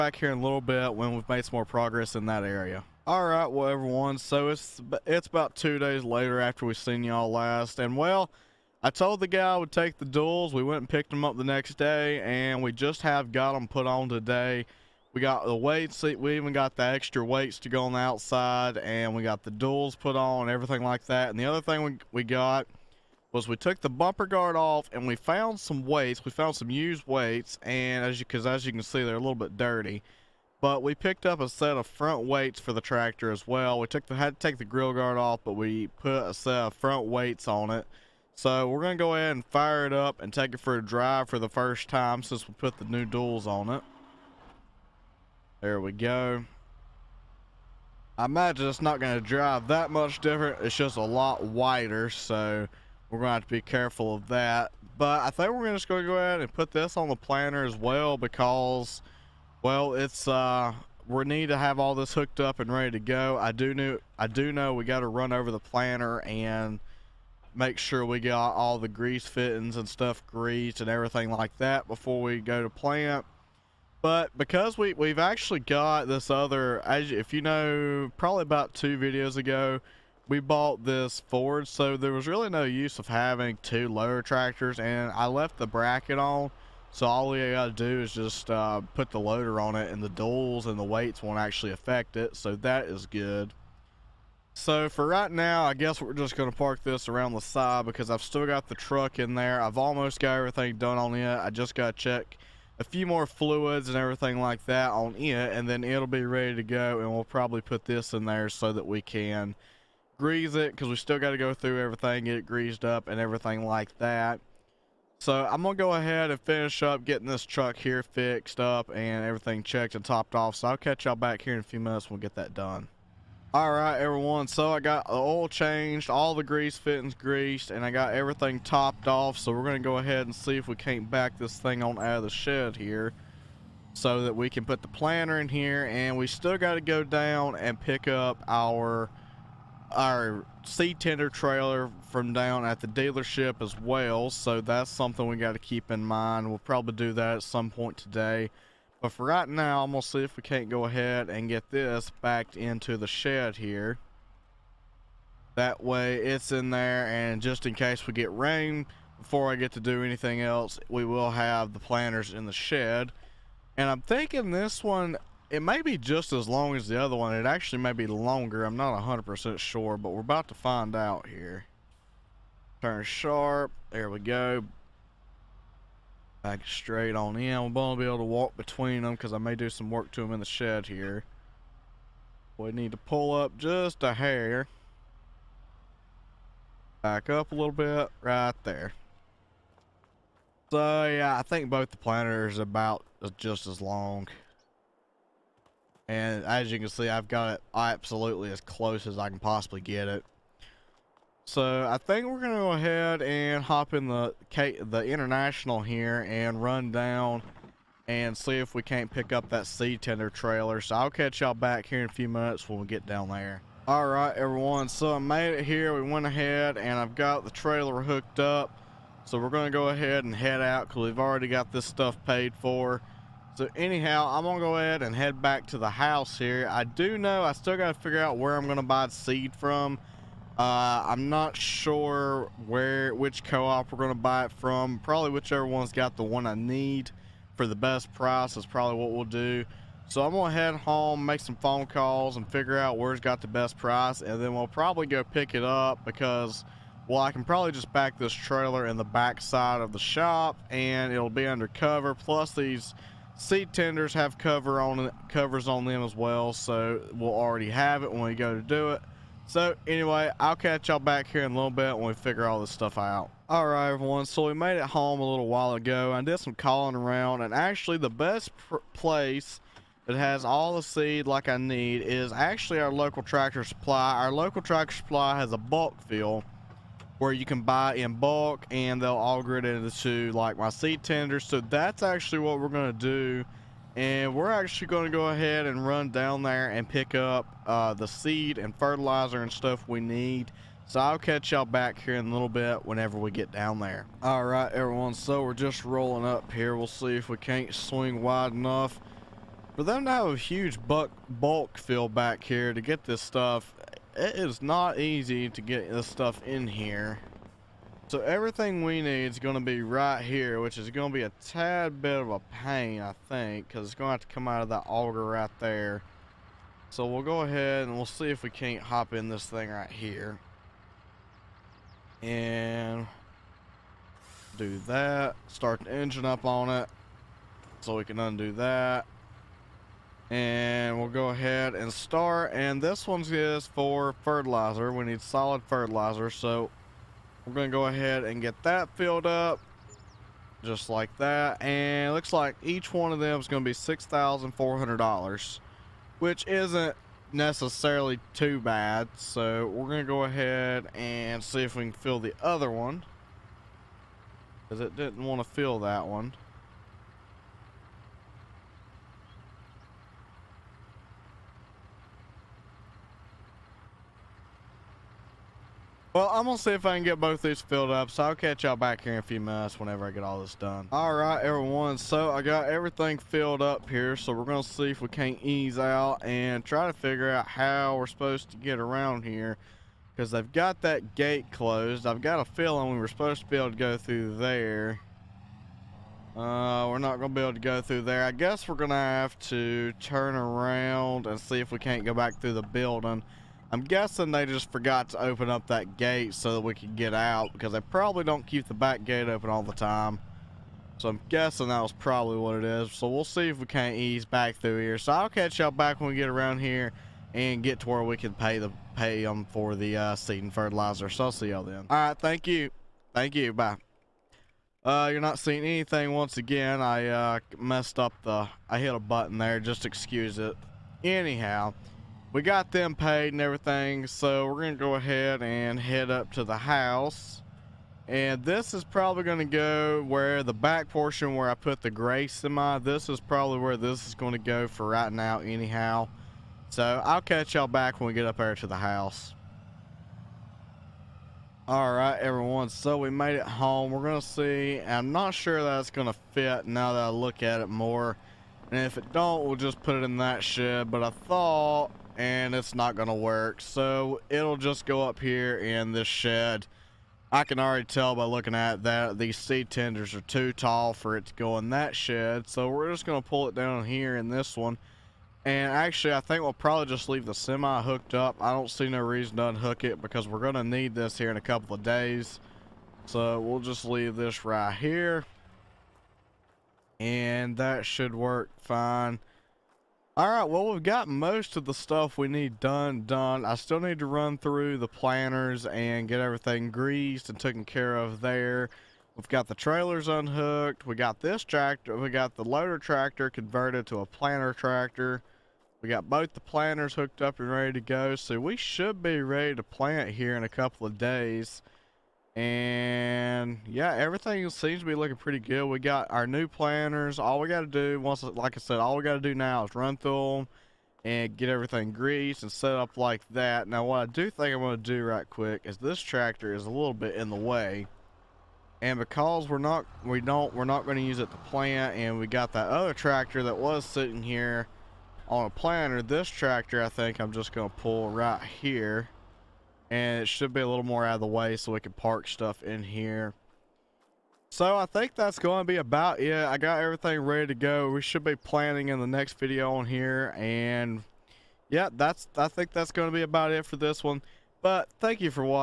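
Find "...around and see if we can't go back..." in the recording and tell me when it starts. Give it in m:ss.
6:30.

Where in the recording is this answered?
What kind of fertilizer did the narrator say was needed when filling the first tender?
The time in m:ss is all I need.
5:35.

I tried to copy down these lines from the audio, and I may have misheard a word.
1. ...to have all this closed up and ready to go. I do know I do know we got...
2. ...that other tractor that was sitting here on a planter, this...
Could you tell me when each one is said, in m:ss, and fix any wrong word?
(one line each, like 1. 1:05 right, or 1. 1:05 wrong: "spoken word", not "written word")
1. 1:01 wrong: "hooked", not "closed"
2. 8:42 right.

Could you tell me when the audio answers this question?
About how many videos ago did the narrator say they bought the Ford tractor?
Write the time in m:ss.
1:18.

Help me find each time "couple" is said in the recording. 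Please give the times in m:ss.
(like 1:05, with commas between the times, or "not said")
7:51, 8:20.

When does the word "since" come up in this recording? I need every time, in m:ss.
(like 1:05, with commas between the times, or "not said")
0:42.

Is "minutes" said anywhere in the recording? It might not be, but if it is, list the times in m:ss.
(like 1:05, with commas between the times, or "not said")
2:01, 3:32, 6:09.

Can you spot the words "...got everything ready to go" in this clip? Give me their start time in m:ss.
8:56.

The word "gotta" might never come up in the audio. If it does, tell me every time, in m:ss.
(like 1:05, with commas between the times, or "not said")
1:27, 1:41, 3:47.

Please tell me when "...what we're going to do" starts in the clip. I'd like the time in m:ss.
4:42.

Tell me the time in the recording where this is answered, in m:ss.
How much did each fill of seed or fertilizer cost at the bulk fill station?
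5:43.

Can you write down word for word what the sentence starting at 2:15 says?
And we still got to go down and pick up our our seed tender trailer from down at the dealership as well.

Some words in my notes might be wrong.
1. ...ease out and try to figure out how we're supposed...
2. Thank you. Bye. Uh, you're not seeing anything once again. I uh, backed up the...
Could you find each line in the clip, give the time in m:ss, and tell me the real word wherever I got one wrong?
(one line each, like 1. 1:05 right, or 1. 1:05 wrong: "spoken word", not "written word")
1. 6:15 right
2. 6:53 wrong: "messed", not "backed".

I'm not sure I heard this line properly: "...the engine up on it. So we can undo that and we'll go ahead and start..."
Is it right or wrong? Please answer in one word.
right.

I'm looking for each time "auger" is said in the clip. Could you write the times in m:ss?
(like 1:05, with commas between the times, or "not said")
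4:39, 5:14.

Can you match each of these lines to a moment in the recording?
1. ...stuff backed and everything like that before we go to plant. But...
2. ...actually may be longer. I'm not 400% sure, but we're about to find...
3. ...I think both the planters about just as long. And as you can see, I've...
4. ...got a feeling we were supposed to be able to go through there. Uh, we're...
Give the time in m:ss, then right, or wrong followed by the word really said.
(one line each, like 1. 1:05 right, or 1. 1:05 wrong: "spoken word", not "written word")
1. 1:09 wrong: "greased", not "backed"
2. 2:47 wrong: "100", not "400"
3. 3:11 right
4. 6:22 right.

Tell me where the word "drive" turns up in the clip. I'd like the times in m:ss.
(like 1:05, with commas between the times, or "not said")
0:40, 0:49.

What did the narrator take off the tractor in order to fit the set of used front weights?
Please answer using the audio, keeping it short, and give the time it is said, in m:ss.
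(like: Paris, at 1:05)
Grill guard, at 0:34.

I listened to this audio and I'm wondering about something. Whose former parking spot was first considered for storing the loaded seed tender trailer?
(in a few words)
Gray semi.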